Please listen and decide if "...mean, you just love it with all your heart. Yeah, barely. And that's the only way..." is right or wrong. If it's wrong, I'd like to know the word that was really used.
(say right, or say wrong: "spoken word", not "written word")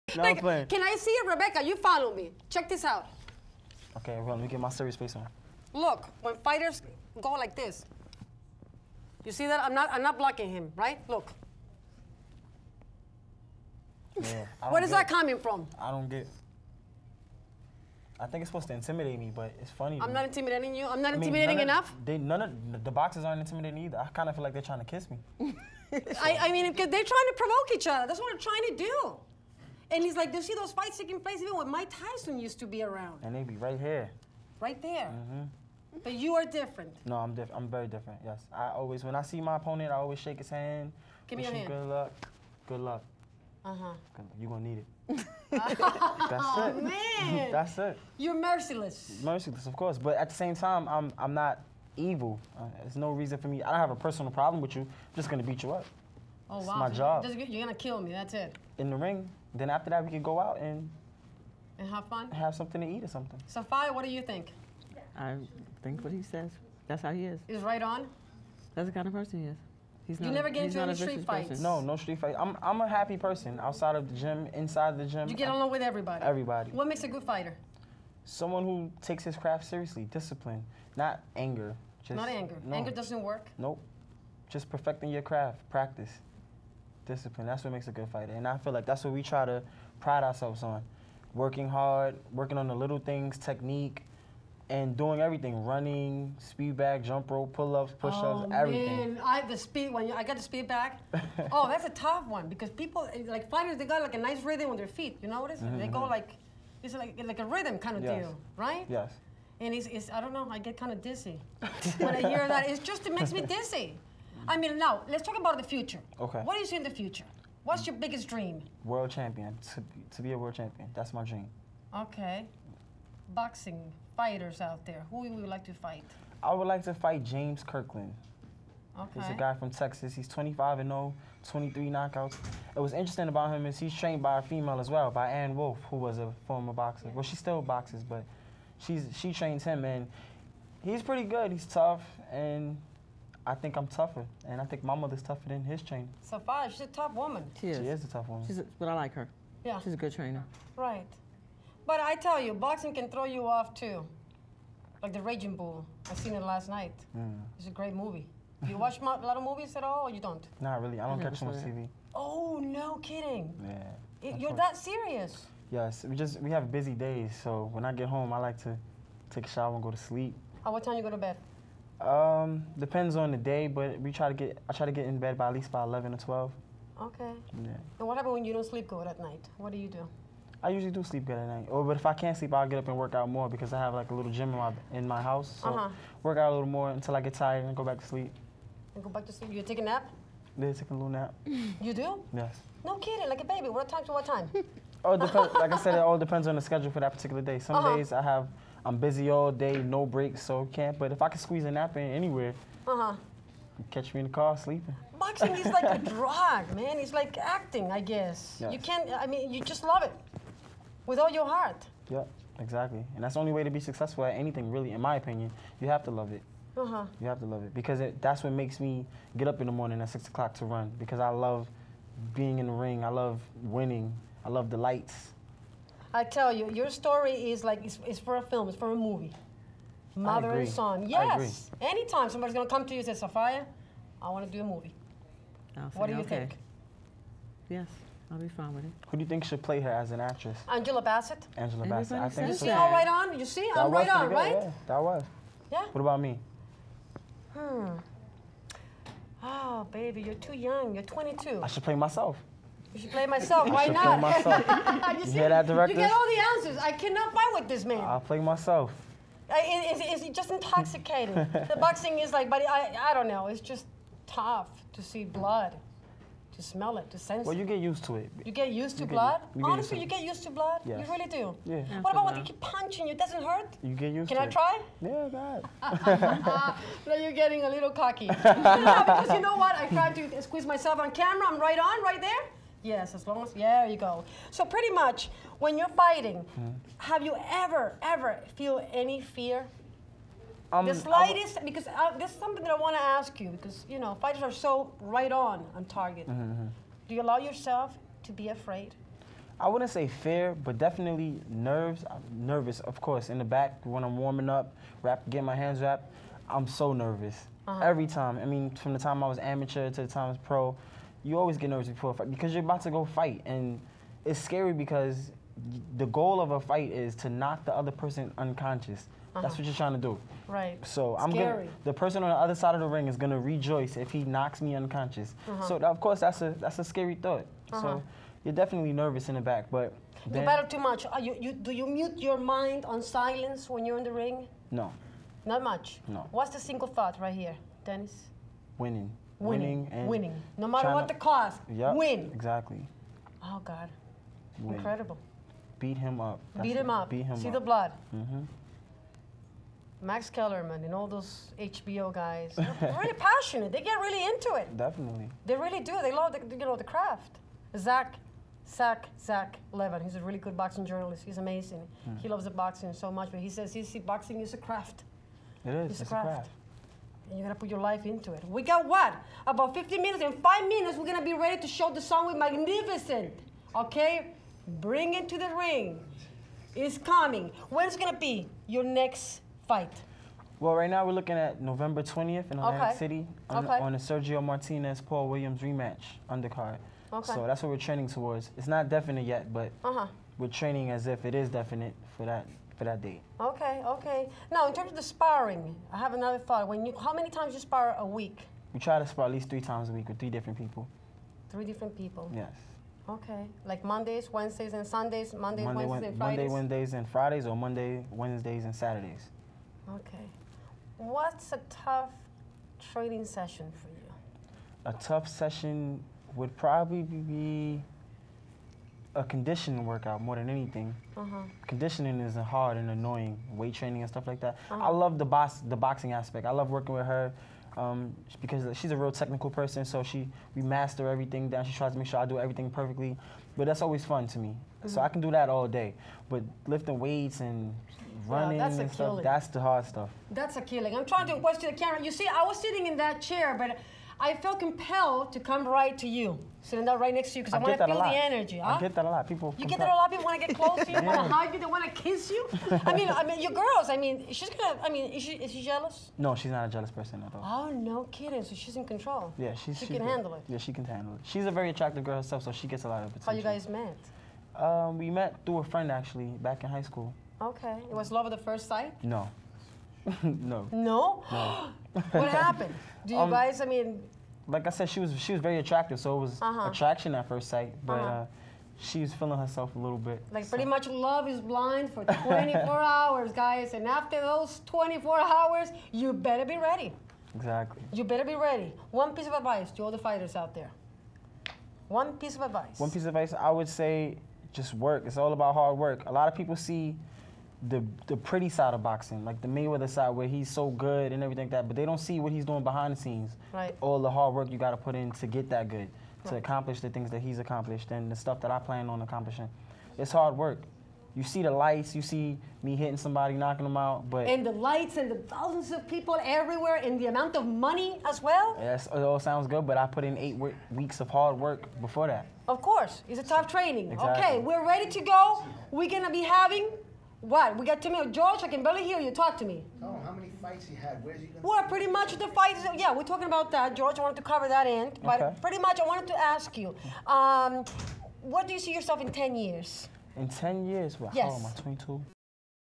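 wrong: "exactly", not "barely".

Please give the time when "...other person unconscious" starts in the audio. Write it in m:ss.
5:17.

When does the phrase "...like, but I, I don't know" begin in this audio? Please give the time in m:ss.
4:22.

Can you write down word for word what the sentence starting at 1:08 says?
That's the kind of person he is.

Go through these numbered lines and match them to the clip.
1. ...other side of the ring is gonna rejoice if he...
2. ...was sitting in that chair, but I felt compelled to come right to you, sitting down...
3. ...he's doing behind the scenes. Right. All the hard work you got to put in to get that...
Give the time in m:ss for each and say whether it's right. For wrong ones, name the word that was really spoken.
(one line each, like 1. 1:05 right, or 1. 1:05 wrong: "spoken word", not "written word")
1. 5:22 right
2. 7:22 right
3. 8:22 right.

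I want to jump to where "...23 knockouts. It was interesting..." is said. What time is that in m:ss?
2:11.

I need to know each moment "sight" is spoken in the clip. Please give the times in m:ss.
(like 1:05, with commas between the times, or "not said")
7:48, 7:57.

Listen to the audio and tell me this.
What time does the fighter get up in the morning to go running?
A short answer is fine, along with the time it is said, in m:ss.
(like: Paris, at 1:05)
6 o'clock, at 3:40.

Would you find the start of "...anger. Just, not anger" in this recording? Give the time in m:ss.
1:21.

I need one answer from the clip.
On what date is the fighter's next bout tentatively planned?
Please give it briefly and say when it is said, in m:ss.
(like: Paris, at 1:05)
November 20th, at 6:21.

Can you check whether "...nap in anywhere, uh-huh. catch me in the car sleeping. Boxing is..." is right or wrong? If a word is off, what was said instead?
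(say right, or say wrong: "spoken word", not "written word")
right.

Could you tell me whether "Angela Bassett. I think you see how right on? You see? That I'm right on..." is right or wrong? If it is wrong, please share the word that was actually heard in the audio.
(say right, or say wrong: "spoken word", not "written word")
right.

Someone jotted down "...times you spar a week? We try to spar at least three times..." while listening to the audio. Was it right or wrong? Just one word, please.
right.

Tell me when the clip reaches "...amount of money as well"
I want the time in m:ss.
8:37.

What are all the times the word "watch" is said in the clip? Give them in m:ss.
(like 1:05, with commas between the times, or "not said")
2:38, 7:21.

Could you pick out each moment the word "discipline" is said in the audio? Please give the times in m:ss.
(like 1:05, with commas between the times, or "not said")
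1:20, 1:27.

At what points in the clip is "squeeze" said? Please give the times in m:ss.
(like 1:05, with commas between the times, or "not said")
3:21, 4:40.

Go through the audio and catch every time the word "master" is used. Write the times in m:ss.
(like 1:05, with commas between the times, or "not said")
7:10.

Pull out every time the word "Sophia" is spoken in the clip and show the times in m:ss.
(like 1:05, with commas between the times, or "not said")
1:03, 3:53.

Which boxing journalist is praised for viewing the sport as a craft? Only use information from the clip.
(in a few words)
Zach Levin.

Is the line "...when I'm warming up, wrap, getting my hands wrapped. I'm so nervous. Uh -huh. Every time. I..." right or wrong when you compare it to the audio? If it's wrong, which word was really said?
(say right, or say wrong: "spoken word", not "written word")
right.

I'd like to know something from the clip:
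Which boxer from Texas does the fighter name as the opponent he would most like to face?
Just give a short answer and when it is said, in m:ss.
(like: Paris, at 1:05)
James Kirkland, at 2:07.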